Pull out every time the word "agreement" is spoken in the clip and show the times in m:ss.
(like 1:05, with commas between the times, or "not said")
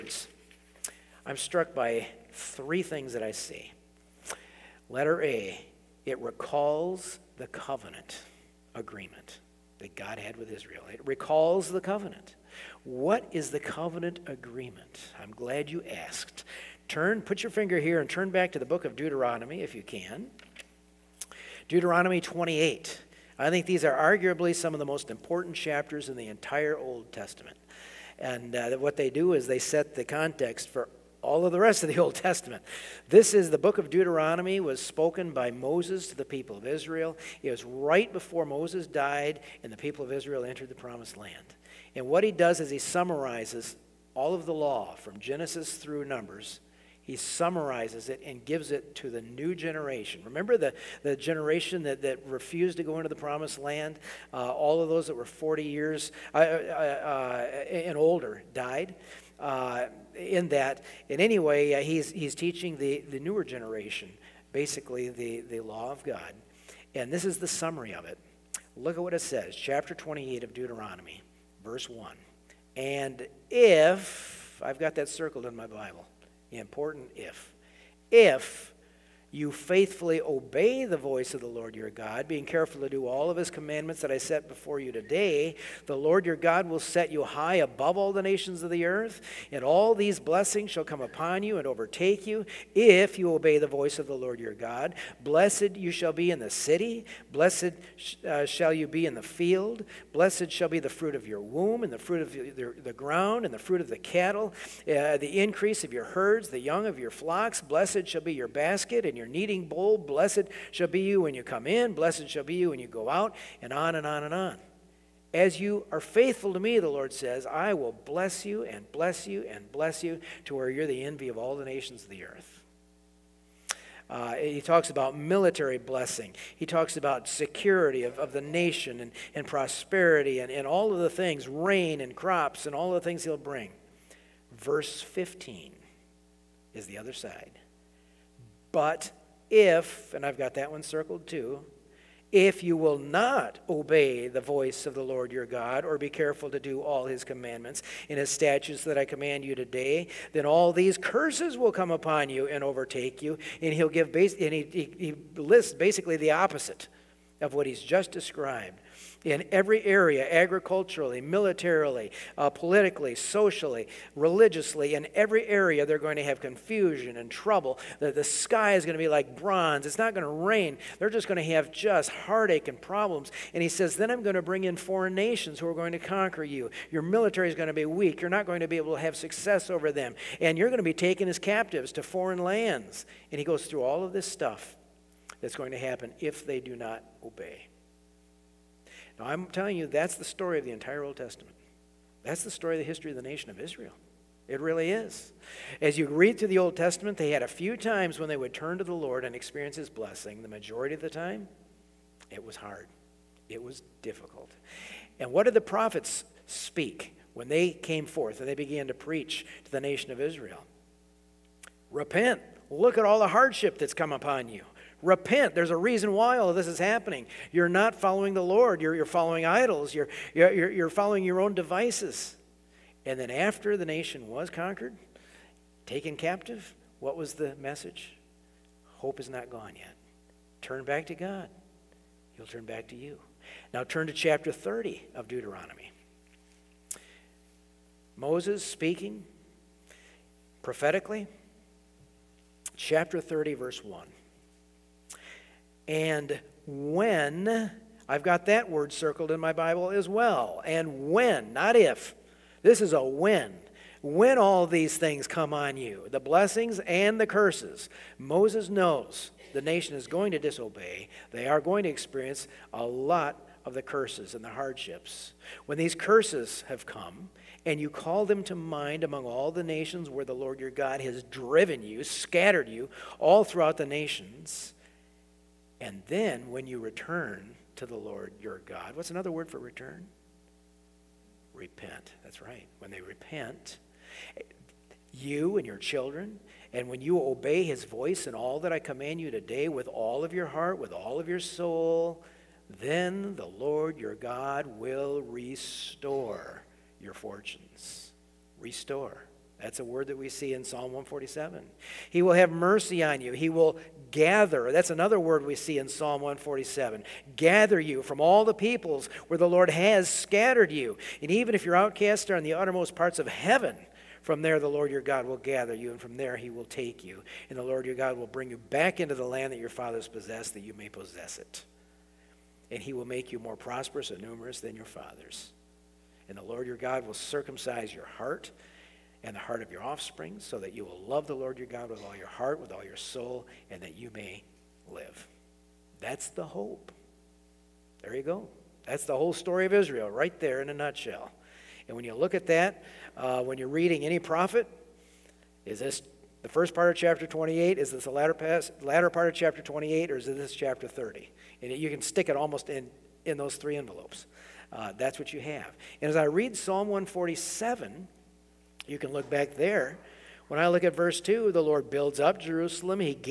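0:08, 0:14.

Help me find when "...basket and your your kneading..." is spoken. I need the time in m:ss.
1:48.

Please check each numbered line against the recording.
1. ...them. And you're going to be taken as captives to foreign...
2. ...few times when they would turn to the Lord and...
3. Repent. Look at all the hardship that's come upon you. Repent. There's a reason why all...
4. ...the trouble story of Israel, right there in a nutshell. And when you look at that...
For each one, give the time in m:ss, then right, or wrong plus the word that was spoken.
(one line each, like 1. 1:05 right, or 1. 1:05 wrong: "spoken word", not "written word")
1. 2:59 right
2. 3:17 right
3. 3:31 right
4. 5:39 wrong: "whole", not "trouble".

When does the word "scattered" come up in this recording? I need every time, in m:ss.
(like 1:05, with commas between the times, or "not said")
4:32, 5:10.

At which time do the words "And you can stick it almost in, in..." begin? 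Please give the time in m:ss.
5:51.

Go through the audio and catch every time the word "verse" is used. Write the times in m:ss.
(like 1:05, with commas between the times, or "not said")
1:11, 2:14, 4:03, 6:00.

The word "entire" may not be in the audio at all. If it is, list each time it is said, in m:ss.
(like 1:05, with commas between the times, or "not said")
0:26, 3:10.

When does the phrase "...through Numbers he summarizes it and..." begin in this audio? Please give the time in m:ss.
0:45.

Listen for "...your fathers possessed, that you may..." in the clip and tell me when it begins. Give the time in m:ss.
5:19.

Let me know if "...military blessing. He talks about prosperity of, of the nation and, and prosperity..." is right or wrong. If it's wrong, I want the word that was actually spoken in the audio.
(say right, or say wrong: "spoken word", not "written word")
wrong: "security", not "prosperity".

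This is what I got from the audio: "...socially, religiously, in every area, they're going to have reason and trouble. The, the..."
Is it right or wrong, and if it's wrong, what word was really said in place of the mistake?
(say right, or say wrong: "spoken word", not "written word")
wrong: "confusion", not "reason".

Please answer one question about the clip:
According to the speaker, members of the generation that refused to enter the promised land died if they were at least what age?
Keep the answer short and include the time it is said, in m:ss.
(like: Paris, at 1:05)
40, at 0:55.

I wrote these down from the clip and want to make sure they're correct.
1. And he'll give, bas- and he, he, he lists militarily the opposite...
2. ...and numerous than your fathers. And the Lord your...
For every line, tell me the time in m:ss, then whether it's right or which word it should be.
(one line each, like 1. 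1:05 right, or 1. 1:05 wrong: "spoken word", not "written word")
1. 2:33 wrong: "basically", not "militarily"
2. 5:24 right.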